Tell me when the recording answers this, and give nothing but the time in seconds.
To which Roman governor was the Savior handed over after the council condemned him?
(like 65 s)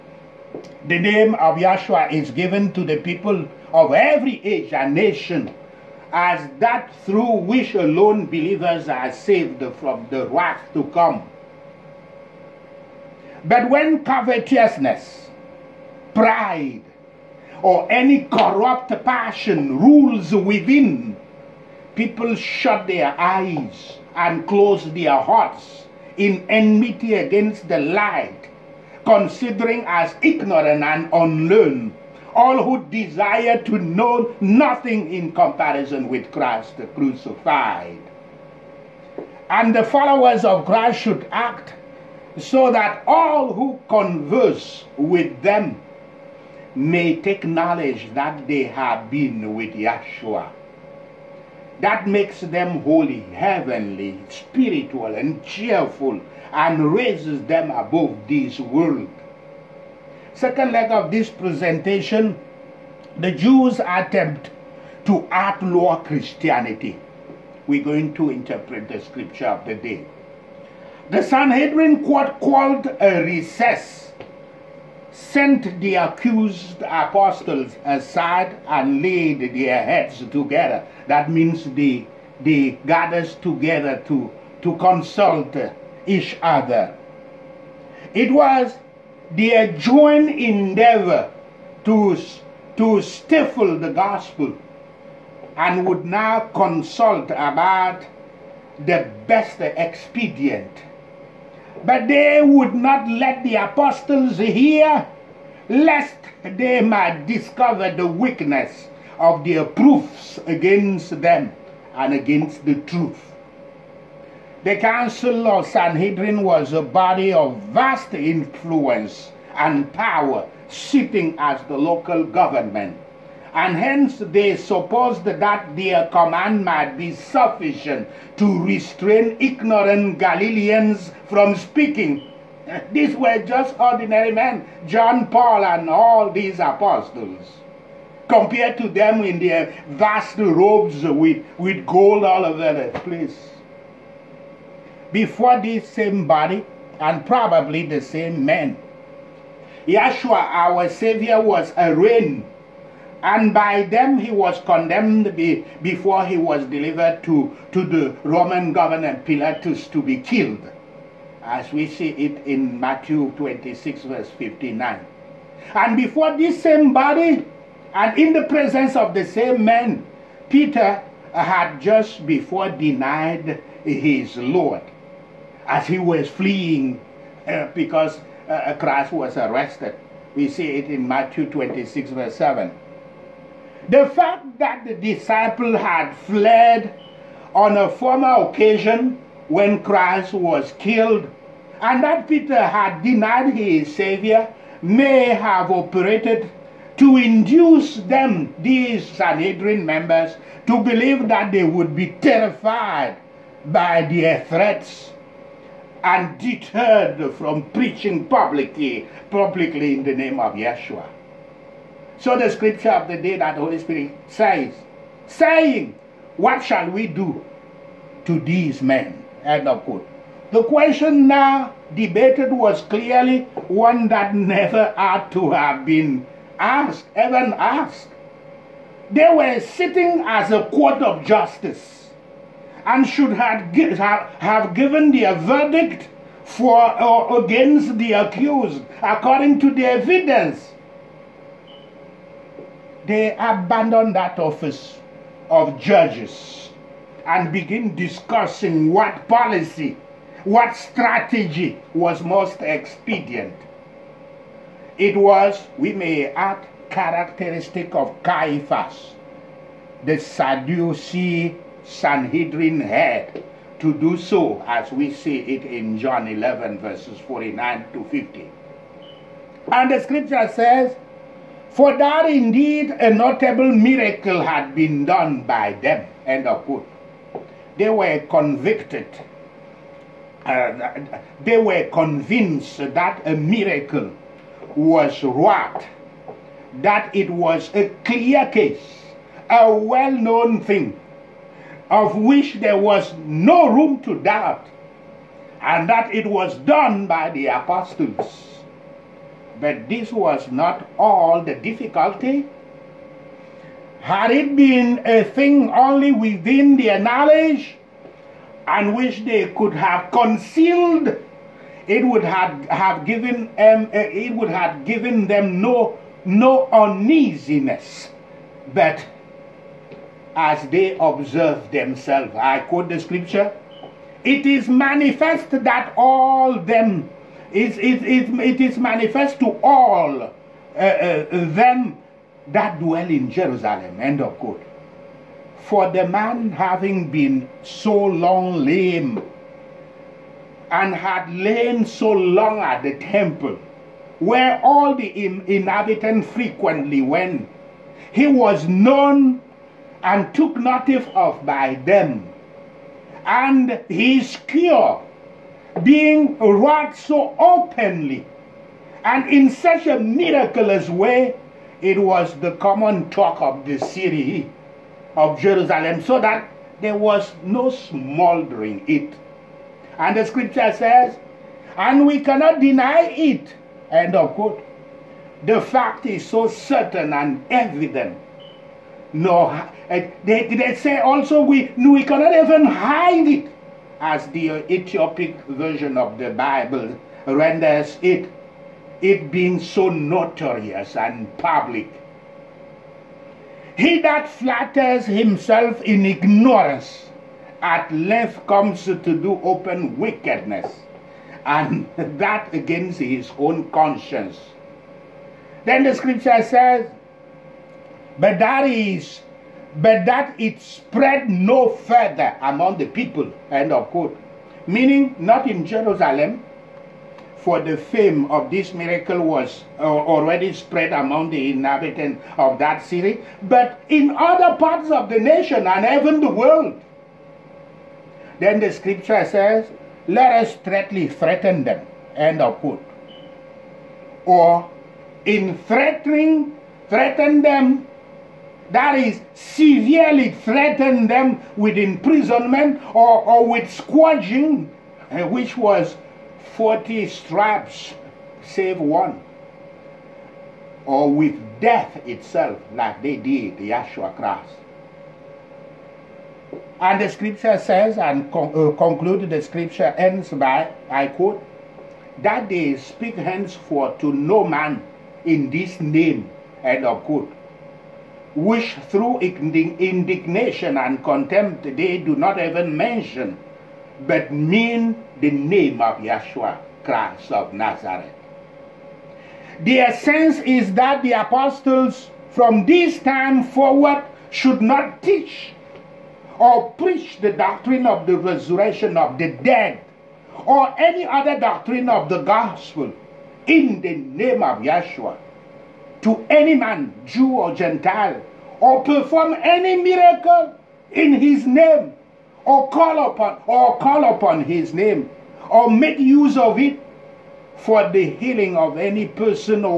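159 s.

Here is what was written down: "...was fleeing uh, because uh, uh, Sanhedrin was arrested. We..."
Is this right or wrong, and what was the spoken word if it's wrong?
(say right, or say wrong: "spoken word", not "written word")
wrong: "Christ", not "Sanhedrin".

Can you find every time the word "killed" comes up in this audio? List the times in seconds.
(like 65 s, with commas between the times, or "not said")
160 s, 190 s.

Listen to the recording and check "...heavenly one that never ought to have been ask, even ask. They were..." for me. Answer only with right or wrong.
wrong.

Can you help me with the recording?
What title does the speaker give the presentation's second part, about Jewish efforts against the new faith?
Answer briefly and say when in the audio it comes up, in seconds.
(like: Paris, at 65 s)
The Jews' attempt to outlaw Christianity, at 63 s.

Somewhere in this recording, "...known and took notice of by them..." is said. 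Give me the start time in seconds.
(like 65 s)
348 s.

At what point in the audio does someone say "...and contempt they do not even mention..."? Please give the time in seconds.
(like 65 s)
470 s.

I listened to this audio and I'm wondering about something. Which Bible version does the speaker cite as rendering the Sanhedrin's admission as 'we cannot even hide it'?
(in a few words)
Ethiopic version.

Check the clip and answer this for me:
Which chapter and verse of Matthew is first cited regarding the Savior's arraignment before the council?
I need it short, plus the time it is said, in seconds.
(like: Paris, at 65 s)
Matthew 26:59, at 162 s.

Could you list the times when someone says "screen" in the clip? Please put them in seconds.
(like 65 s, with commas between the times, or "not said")
not said.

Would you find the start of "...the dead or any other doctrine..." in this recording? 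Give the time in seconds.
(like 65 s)
489 s.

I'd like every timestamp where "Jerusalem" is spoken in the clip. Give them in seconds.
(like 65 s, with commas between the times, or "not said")
333 s, 365 s, 415 s.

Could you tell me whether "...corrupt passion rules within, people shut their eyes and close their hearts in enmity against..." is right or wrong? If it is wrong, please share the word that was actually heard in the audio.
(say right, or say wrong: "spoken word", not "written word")
right.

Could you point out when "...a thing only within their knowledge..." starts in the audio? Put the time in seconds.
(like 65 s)
305 s.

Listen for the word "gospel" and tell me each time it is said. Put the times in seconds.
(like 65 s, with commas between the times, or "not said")
93 s, 492 s.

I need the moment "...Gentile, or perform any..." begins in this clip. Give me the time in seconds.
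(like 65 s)
497 s.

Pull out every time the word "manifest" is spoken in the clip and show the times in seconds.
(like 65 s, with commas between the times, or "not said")
324 s, 328 s.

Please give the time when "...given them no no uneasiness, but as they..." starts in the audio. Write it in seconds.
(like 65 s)
314 s.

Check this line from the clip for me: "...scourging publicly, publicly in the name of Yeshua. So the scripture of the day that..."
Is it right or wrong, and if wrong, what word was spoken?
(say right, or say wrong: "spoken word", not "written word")
wrong: "preaching", not "scourging".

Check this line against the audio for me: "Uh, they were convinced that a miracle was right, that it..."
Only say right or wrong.
right.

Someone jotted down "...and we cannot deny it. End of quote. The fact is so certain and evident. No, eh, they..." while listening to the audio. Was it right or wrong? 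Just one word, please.
right.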